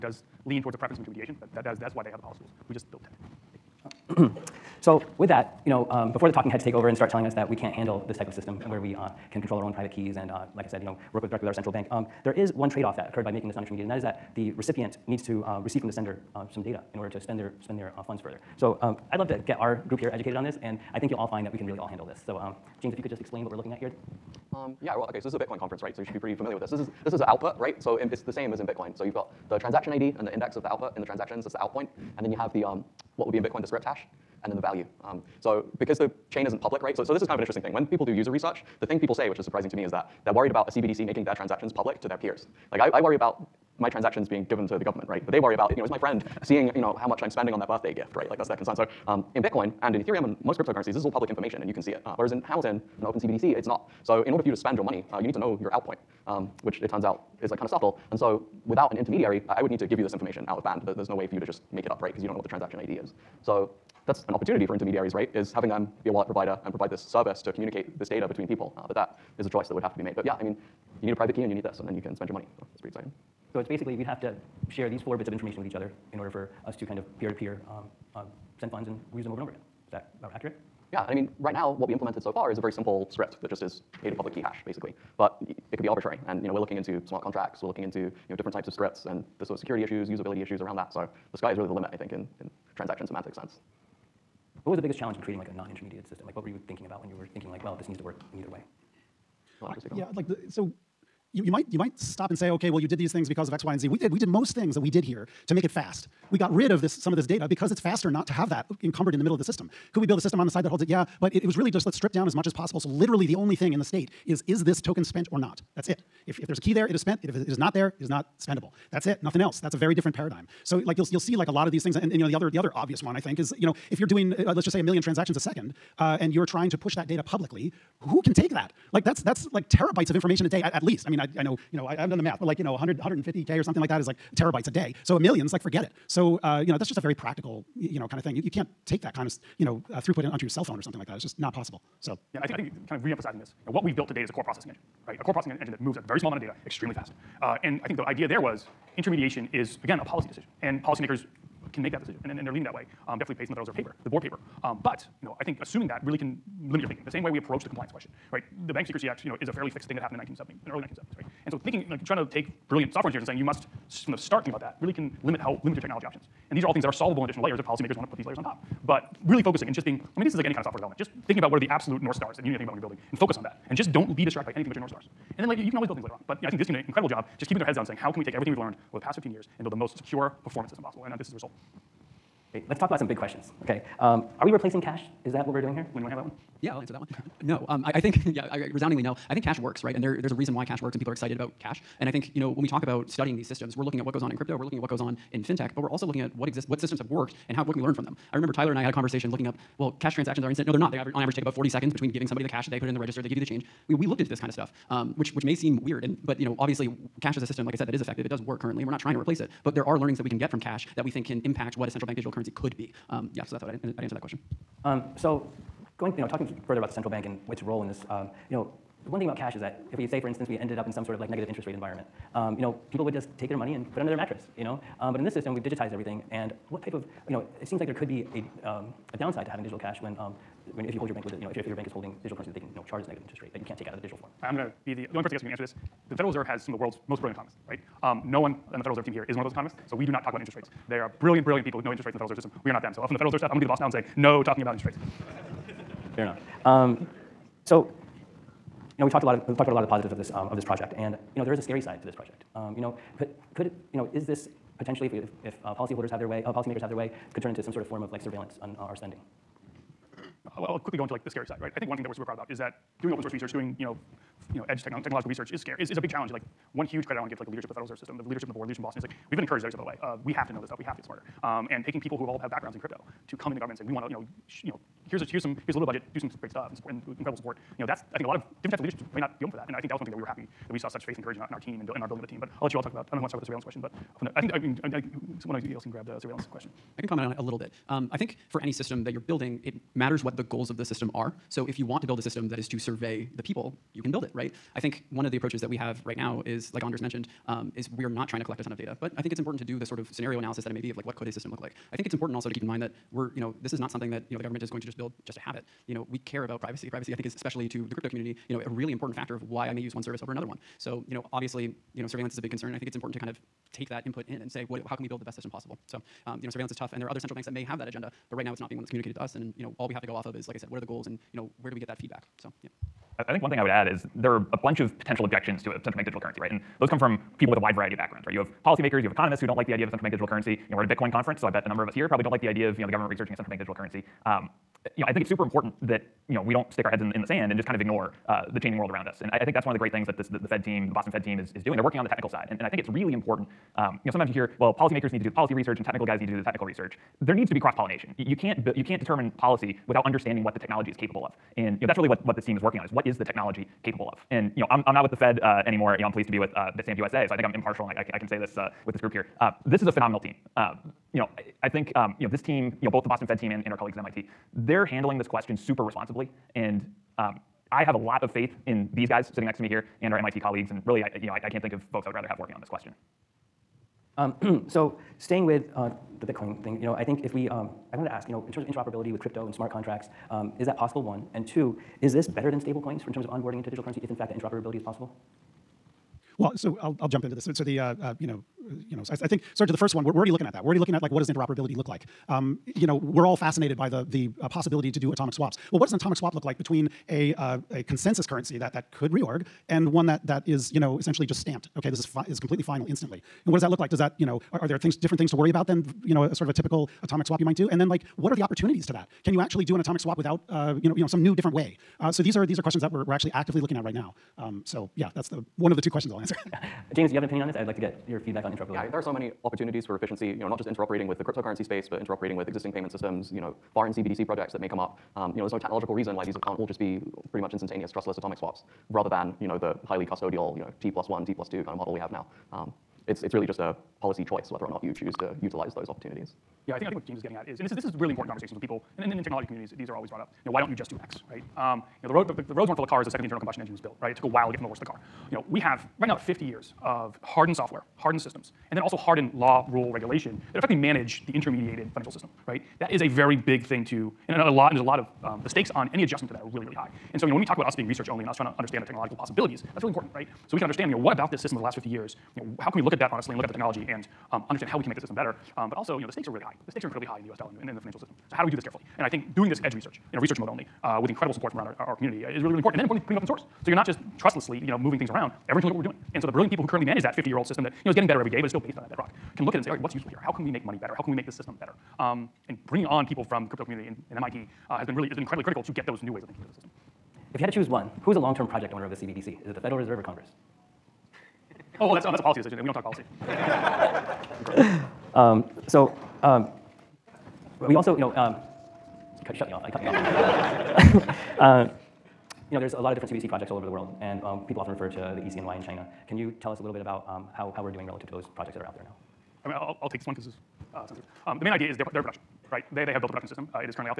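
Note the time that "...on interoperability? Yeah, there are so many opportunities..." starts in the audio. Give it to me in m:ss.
6:58.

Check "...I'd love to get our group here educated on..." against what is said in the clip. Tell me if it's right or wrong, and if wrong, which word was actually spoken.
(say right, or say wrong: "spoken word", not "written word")
right.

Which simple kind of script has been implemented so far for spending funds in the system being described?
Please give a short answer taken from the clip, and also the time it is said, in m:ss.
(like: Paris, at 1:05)
pay to public key hash, at 1:24.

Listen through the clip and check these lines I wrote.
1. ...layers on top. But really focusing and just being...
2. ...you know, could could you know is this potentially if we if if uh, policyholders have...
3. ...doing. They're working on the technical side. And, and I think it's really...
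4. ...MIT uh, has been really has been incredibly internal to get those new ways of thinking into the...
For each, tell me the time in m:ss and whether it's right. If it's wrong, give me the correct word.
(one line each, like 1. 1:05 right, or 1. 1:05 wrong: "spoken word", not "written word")
1. 2:48 right
2. 4:12 right
3. 5:41 right
4. 8:04 wrong: "critical", not "internal".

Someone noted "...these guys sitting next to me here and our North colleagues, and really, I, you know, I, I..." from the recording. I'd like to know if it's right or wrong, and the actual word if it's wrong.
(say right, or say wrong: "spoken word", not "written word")
wrong: "MIT", not "North".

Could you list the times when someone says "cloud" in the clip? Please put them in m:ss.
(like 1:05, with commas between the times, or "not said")
not said.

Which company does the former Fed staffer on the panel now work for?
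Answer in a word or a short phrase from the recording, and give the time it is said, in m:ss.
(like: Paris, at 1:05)
Bitstamp USA, at 5:56.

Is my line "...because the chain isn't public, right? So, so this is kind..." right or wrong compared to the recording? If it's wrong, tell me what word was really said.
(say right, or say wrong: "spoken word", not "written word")
right.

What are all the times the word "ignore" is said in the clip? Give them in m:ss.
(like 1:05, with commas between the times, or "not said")
5:37.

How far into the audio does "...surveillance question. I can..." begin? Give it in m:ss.
4:46.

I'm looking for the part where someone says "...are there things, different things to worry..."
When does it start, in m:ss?
6:44.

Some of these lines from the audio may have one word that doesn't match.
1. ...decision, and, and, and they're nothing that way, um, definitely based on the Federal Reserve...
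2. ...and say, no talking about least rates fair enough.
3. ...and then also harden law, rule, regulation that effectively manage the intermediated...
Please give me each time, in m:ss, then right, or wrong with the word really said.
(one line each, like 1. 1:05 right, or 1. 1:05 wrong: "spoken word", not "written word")
1. 2:31 wrong: "leaning", not "nothing"
2. 4:03 wrong: "interest", not "least"
3. 7:28 right.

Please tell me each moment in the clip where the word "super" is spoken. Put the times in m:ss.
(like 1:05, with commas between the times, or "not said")
4:22, 5:35, 6:05.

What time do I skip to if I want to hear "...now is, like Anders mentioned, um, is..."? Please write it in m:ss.
4:56.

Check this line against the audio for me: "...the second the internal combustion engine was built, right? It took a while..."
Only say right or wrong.
right.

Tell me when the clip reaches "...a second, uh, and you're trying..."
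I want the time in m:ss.
2:05.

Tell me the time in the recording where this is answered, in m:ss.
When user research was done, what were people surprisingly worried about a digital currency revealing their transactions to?
0:42.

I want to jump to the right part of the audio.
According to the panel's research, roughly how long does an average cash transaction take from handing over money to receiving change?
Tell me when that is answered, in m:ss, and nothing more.
3:21.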